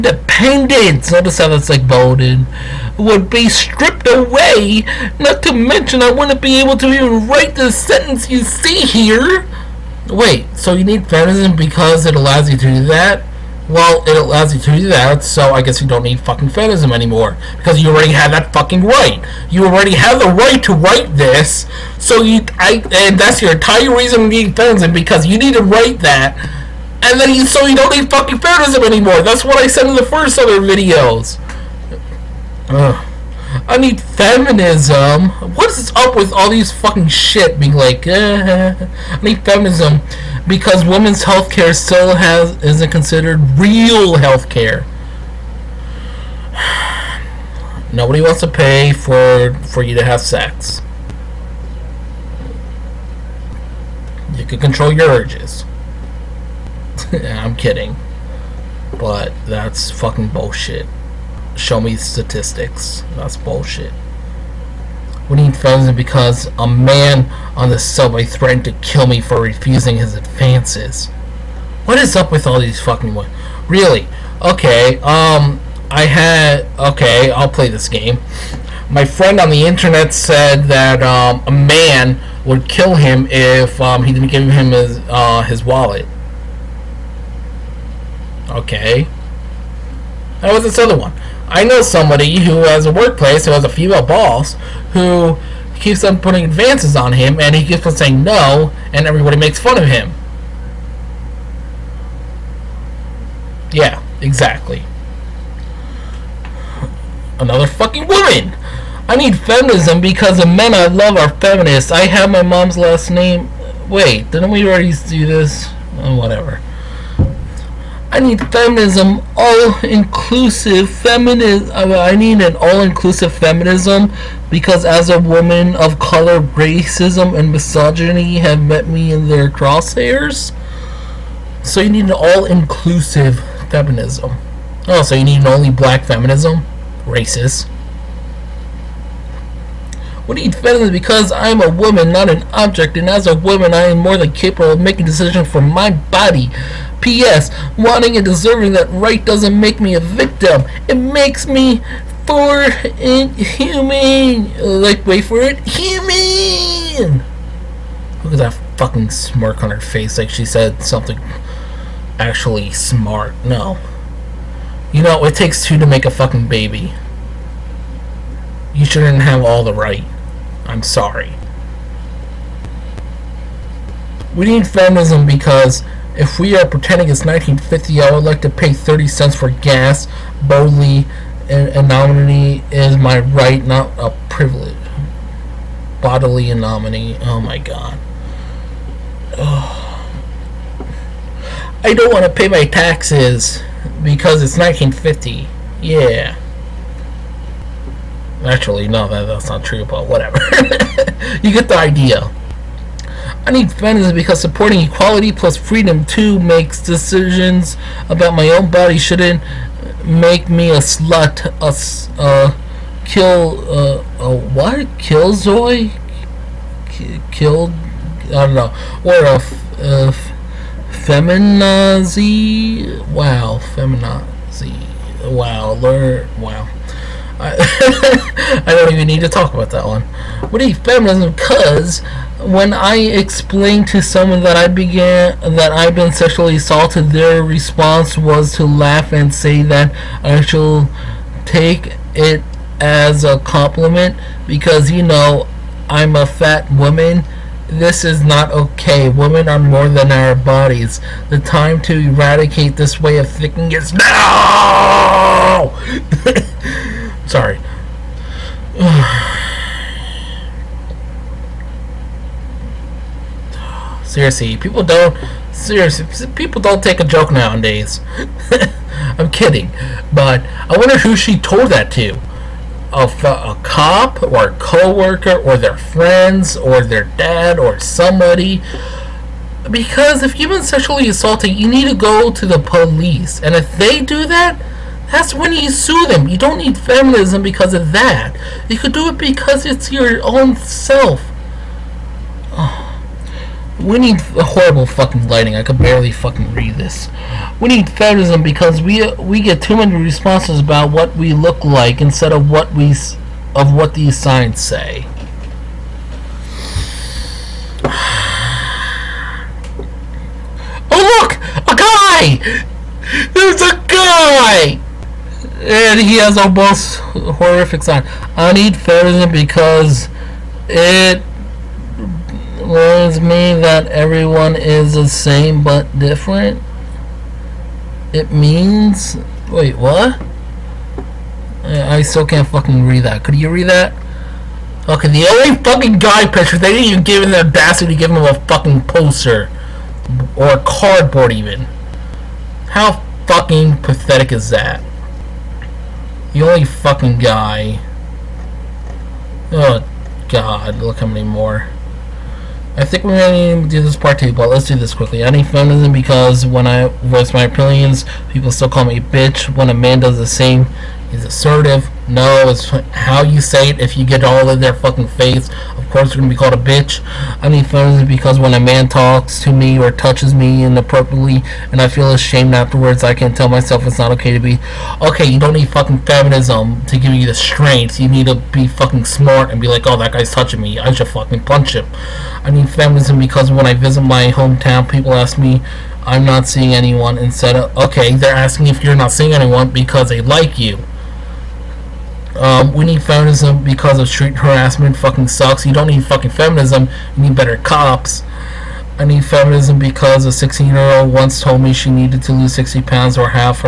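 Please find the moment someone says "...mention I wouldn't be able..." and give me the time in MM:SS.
00:05.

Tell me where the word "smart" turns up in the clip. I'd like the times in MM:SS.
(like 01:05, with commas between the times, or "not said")
02:42, 06:19.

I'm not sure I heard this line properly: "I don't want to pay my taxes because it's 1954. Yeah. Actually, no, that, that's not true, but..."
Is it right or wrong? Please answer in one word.
wrong.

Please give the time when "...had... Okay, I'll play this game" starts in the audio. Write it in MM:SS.
01:16.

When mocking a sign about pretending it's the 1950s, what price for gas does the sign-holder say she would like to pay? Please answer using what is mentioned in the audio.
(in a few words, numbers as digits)
30 cents.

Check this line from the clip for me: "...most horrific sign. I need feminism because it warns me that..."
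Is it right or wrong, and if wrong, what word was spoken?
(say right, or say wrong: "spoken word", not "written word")
right.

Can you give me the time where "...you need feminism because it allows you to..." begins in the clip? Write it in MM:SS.
00:10.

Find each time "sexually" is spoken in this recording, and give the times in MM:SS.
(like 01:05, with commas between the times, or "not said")
03:56, 04:40.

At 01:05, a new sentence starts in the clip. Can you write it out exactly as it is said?
We need funds because a man on the subway threatened to kill me for refusing his advances.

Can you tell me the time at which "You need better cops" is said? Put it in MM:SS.
06:37.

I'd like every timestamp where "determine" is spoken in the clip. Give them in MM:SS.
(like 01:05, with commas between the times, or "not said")
not said.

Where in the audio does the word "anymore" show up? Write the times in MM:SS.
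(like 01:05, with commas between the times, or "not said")
00:16, 00:28.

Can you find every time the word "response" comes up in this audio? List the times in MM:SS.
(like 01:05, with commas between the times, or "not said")
03:57, 04:59.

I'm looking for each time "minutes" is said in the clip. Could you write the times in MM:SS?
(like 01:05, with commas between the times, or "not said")
not said.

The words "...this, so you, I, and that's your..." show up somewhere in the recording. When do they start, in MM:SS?
00:21.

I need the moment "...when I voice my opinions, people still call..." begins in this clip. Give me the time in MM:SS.
05:56.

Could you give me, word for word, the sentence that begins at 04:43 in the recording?
And if they do that, that's when you sue them.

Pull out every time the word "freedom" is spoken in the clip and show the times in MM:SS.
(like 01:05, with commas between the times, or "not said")
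03:25.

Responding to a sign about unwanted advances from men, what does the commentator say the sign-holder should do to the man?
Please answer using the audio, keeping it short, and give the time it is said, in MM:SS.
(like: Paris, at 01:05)
punch him, at 06:21.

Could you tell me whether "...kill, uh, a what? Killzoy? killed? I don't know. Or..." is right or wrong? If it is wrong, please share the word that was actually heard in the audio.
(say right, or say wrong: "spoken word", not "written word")
right.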